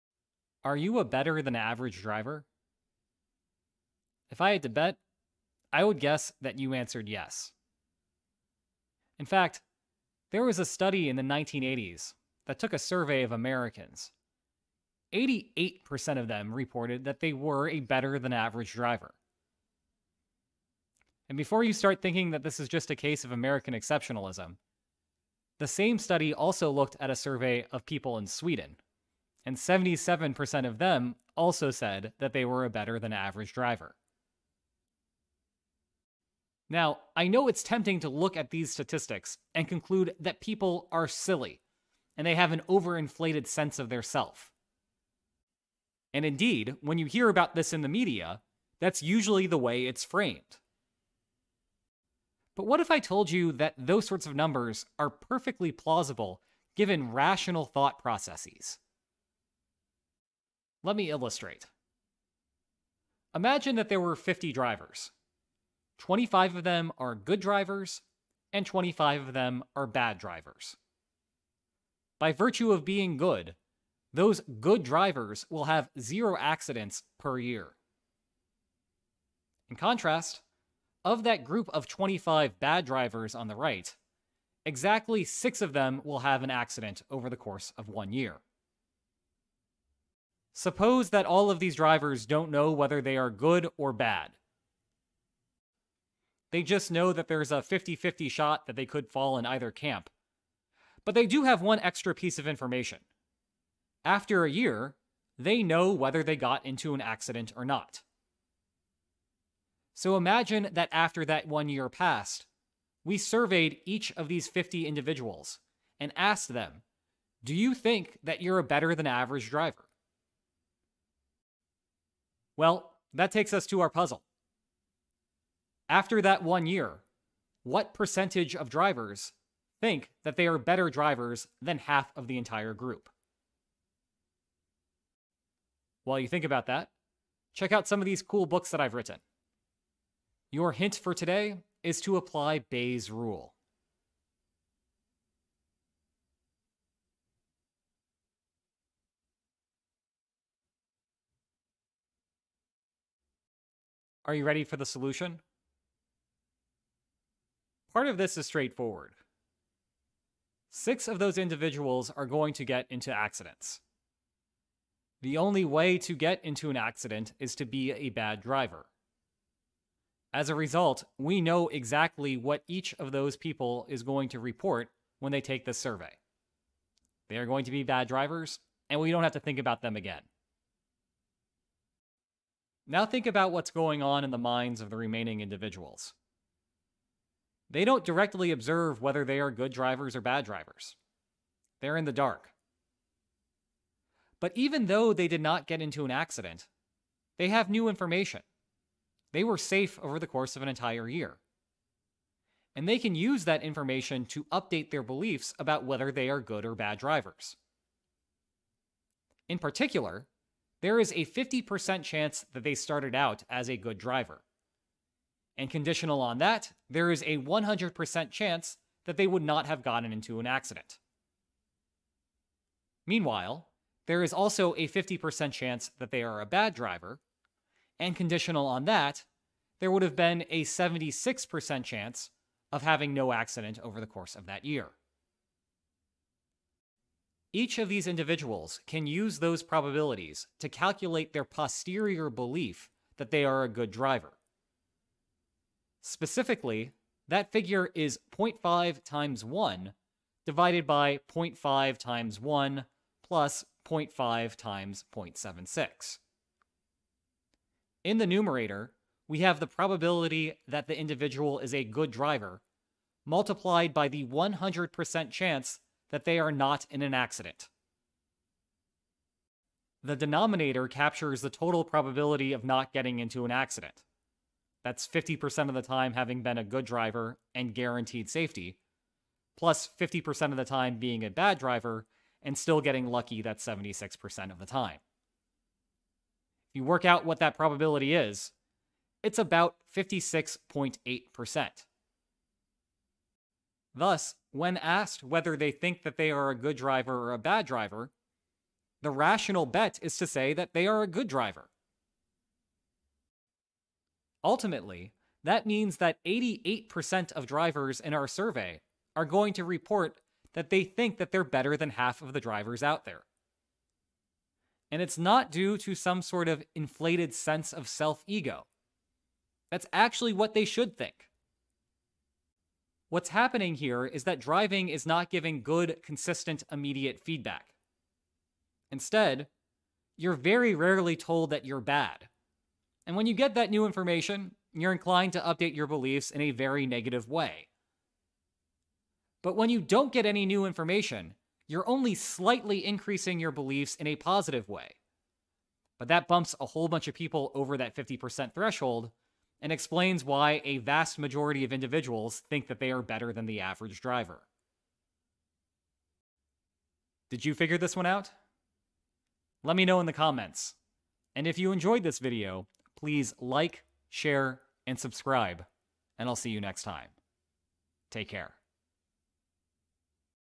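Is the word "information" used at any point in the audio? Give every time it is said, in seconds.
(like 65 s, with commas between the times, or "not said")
102 s, 197 s, 203 s, 333 s, 340 s.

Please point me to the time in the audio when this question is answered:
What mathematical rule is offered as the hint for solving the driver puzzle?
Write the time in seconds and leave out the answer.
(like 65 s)
142 s.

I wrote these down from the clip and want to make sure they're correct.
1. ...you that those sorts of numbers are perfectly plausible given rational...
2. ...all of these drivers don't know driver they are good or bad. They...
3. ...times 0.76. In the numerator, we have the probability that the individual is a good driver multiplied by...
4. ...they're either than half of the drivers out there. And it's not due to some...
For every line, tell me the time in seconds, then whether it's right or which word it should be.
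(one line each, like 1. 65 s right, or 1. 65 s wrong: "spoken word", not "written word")
1. 53 s right
2. 91 s wrong: "whether", not "driver"
3. 254 s right
4. 311 s wrong: "better", not "either".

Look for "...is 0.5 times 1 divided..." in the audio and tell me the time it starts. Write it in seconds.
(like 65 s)
247 s.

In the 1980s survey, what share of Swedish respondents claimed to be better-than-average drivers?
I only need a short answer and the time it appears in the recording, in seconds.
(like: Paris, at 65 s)
77%, at 29 s.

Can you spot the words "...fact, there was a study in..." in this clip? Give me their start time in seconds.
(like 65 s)
9 s.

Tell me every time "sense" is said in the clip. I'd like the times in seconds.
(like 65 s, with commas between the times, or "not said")
43 s, 317 s.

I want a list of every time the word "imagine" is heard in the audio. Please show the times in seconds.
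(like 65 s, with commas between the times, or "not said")
63 s, 110 s.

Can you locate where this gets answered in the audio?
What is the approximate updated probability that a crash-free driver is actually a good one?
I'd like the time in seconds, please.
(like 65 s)
289 s.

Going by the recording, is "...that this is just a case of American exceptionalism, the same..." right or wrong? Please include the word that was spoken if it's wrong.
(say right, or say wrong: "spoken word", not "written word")
right.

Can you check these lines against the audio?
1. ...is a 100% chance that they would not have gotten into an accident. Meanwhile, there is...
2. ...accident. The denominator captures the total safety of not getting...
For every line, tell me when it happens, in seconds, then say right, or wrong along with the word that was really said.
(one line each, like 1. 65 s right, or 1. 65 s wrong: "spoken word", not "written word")
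1. 217 s right
2. 267 s wrong: "probability", not "safety".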